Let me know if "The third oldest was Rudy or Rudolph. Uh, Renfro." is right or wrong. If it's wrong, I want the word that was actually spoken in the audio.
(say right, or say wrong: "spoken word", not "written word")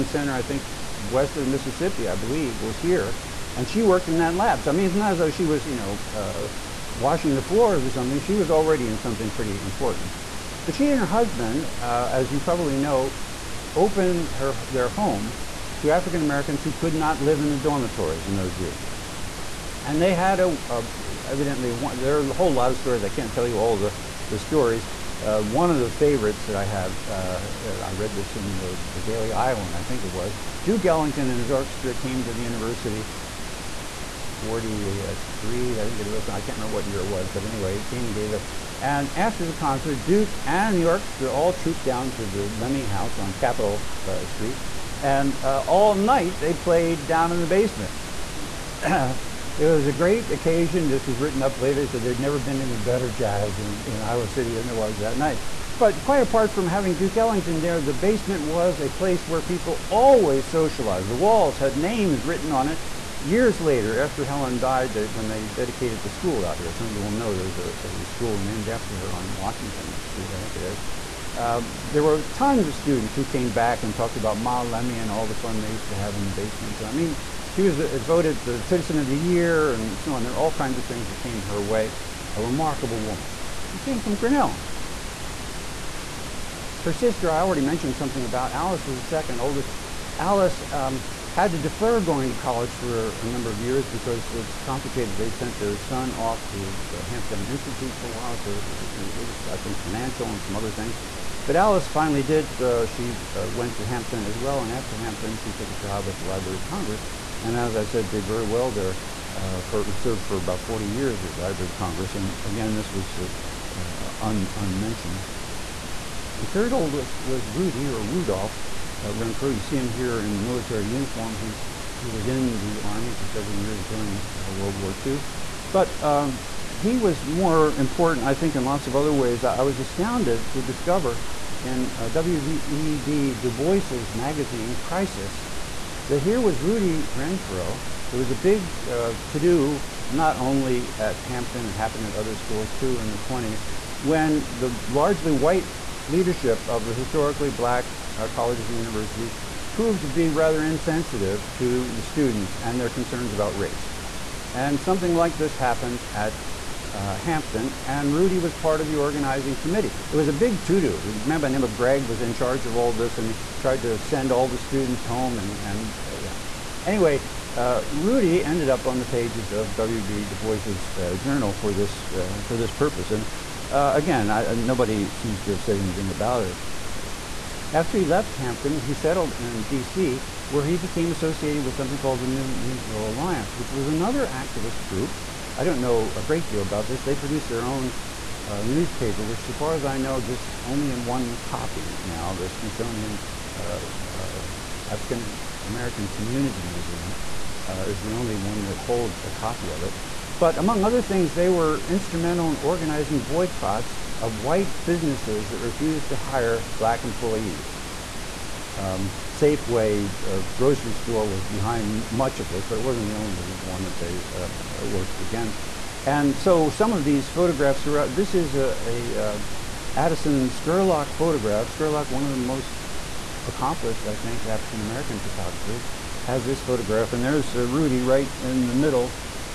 right.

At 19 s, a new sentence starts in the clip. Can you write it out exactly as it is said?
And they had a, a evidently one, there are a whole lot of stories.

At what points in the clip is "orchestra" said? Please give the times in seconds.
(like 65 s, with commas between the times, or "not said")
31 s, 40 s.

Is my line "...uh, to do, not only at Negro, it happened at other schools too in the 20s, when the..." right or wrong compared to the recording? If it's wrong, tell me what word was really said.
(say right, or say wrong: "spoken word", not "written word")
wrong: "Hampton", not "Negro".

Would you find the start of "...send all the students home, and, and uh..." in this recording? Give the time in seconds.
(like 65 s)
163 s.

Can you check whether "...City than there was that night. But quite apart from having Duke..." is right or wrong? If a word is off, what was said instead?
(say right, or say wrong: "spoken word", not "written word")
right.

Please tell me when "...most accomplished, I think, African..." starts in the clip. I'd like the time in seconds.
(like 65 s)
222 s.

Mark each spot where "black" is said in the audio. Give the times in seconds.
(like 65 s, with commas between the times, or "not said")
147 s, 206 s.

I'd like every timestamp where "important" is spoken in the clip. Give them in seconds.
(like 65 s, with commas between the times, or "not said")
9 s, 127 s.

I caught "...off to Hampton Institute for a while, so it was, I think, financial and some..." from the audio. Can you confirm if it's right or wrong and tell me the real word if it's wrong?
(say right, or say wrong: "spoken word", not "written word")
right.